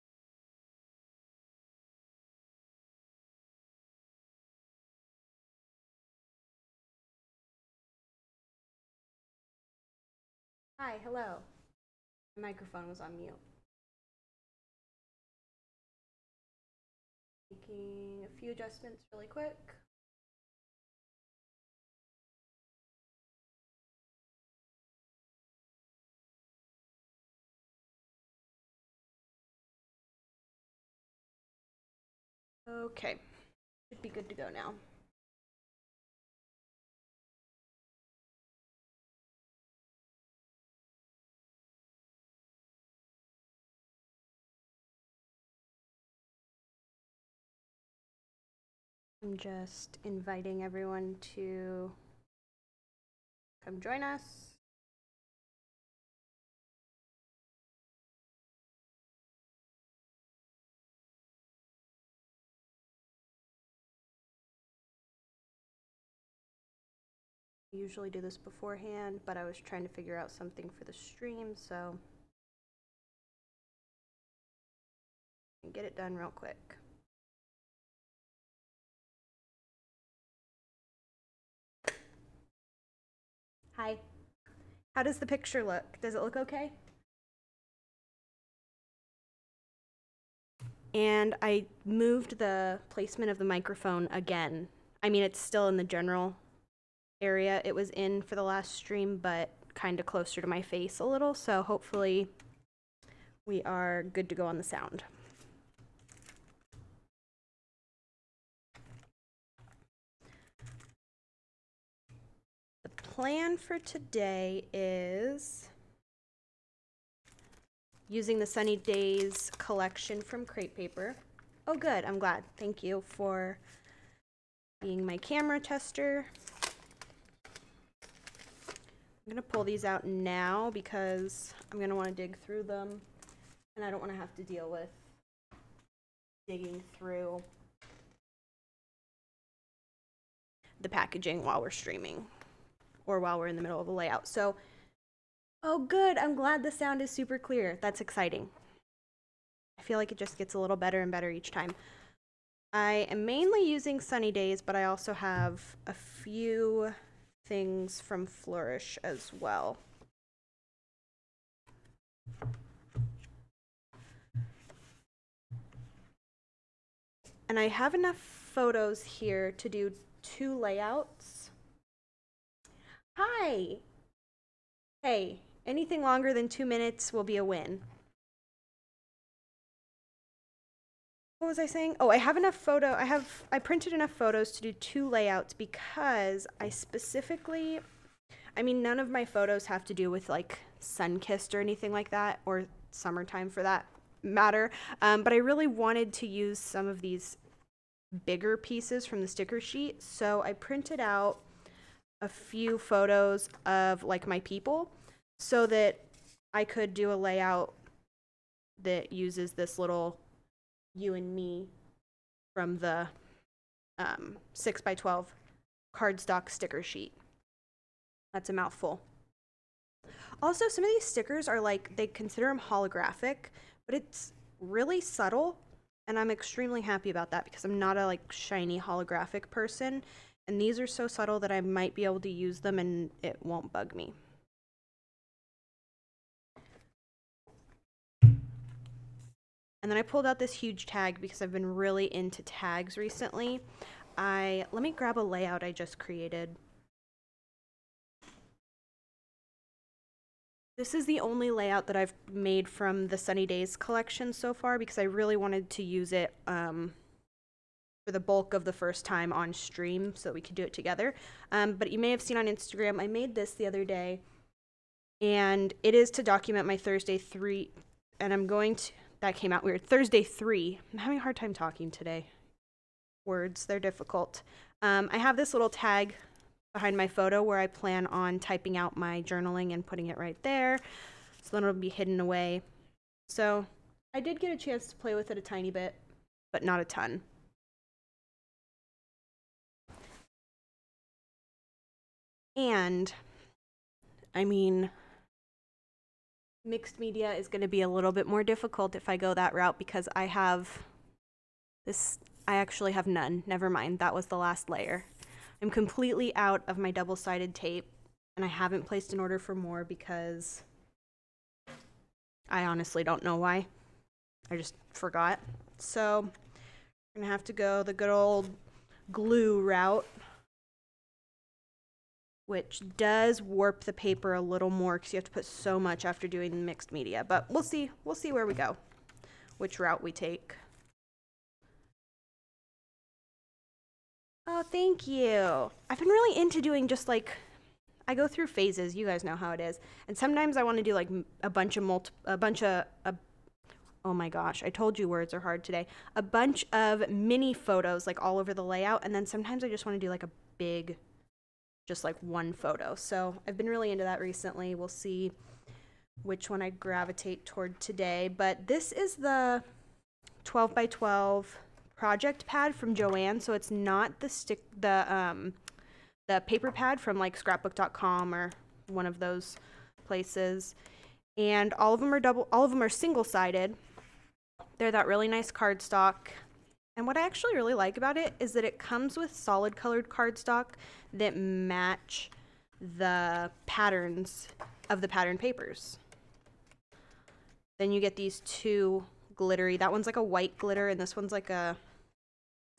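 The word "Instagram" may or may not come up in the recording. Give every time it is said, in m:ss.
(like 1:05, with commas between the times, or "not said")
4:22.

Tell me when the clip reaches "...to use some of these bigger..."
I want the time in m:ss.
3:16.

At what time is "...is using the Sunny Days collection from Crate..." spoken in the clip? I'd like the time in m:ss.
1:54.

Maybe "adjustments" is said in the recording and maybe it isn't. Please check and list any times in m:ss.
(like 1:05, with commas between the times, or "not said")
0:18.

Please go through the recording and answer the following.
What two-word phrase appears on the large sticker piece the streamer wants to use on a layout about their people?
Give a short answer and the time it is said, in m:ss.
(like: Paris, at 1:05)
you and me, at 3:30.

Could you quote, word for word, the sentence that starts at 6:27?
Then you get these two glittery.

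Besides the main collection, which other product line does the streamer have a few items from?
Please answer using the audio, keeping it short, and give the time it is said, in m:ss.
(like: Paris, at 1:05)
Flourish, at 2:38.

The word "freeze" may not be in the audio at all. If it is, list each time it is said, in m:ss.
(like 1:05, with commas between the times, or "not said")
not said.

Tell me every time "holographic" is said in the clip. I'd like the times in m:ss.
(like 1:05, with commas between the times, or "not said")
3:42, 3:48.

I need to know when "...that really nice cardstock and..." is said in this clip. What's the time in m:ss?
6:14.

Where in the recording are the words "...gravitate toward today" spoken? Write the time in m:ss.
5:56.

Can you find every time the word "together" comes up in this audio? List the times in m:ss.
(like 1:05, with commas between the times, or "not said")
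4:20.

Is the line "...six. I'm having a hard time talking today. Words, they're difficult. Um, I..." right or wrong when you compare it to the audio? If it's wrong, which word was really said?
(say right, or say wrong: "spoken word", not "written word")
wrong: "three", not "six".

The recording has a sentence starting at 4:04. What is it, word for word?
I let me grab a layout I just created.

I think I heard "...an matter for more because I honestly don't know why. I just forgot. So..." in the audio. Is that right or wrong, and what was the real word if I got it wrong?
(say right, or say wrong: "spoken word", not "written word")
wrong: "order", not "matter".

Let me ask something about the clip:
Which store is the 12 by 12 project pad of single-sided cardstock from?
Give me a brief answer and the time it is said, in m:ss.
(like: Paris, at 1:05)
JoAnn, at 6:02.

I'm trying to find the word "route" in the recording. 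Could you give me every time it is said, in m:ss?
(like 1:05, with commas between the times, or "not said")
4:59, 5:19, 5:29.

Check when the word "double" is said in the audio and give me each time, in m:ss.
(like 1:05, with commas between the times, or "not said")
5:06, 6:12.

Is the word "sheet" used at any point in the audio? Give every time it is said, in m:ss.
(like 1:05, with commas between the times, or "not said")
3:19, 3:36.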